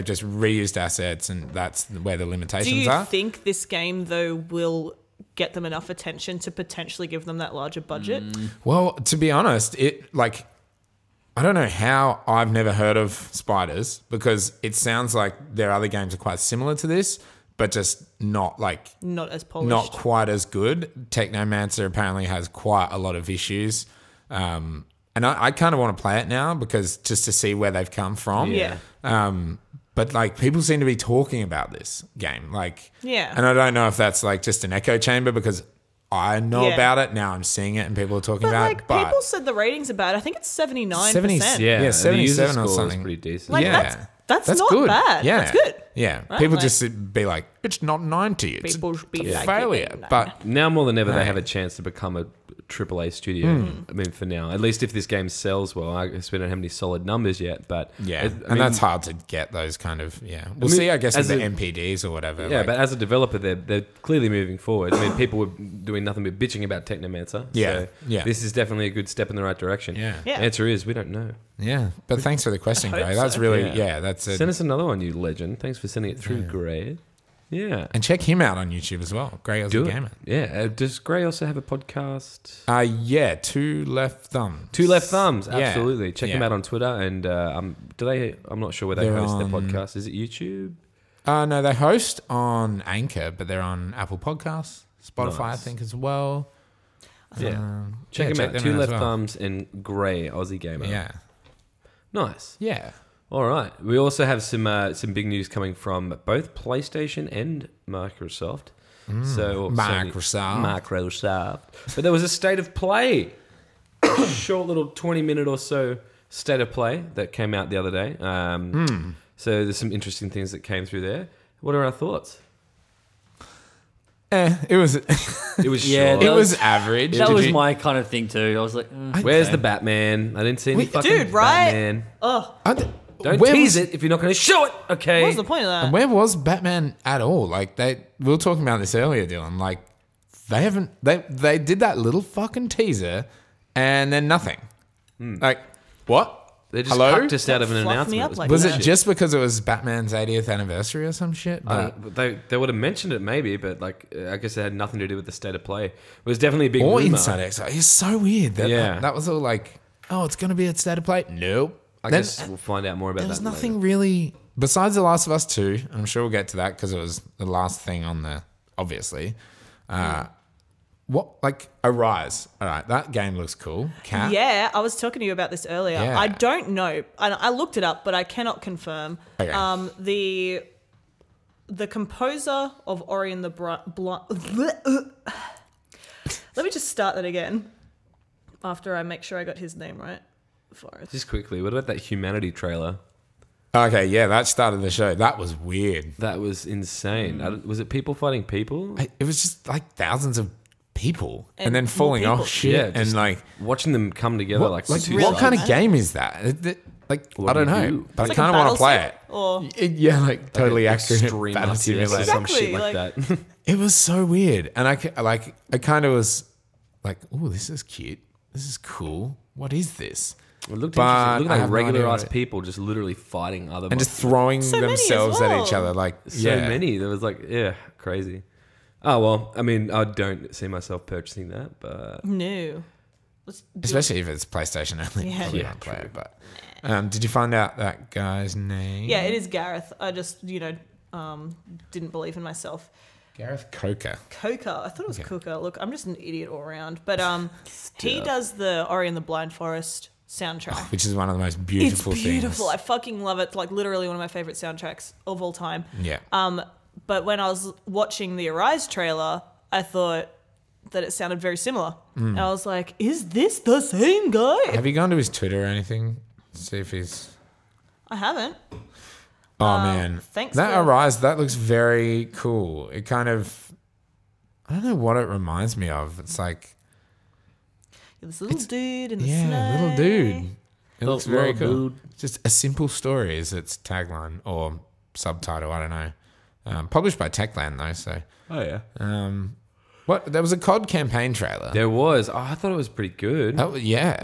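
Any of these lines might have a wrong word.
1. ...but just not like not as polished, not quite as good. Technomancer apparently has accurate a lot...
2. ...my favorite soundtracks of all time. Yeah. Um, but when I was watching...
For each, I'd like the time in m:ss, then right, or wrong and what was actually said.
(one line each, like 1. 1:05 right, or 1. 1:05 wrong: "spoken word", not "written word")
1. 0:17 wrong: "quite", not "accurate"
2. 4:14 right.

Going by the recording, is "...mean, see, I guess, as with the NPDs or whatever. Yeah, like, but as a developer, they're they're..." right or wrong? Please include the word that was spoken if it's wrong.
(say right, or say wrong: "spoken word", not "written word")
right.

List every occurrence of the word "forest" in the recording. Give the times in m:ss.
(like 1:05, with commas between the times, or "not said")
3:10, 4:09.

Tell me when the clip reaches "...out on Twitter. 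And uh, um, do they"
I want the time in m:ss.
1:26.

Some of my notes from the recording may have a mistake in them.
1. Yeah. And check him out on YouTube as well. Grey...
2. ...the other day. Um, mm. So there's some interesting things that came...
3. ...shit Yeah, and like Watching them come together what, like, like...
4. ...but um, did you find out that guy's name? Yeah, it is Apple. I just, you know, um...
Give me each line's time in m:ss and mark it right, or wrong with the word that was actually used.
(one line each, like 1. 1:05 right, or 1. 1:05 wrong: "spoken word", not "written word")
1. 1:17 right
2. 1:57 right
3. 3:22 right
4. 3:56 wrong: "Gareth", not "Apple".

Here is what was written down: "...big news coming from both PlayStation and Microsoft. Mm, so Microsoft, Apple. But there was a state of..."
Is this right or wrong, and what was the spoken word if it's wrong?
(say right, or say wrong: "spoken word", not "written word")
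wrong: "Microsoft", not "Apple".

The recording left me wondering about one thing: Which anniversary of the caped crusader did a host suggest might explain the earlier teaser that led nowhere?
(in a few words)
80th.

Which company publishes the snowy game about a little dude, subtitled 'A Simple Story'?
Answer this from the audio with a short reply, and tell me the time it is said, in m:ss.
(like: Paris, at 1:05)
Techland, at 4:47.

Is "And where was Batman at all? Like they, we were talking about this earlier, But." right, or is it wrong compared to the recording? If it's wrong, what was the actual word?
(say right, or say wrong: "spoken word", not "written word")
wrong: "Dylan", not "But".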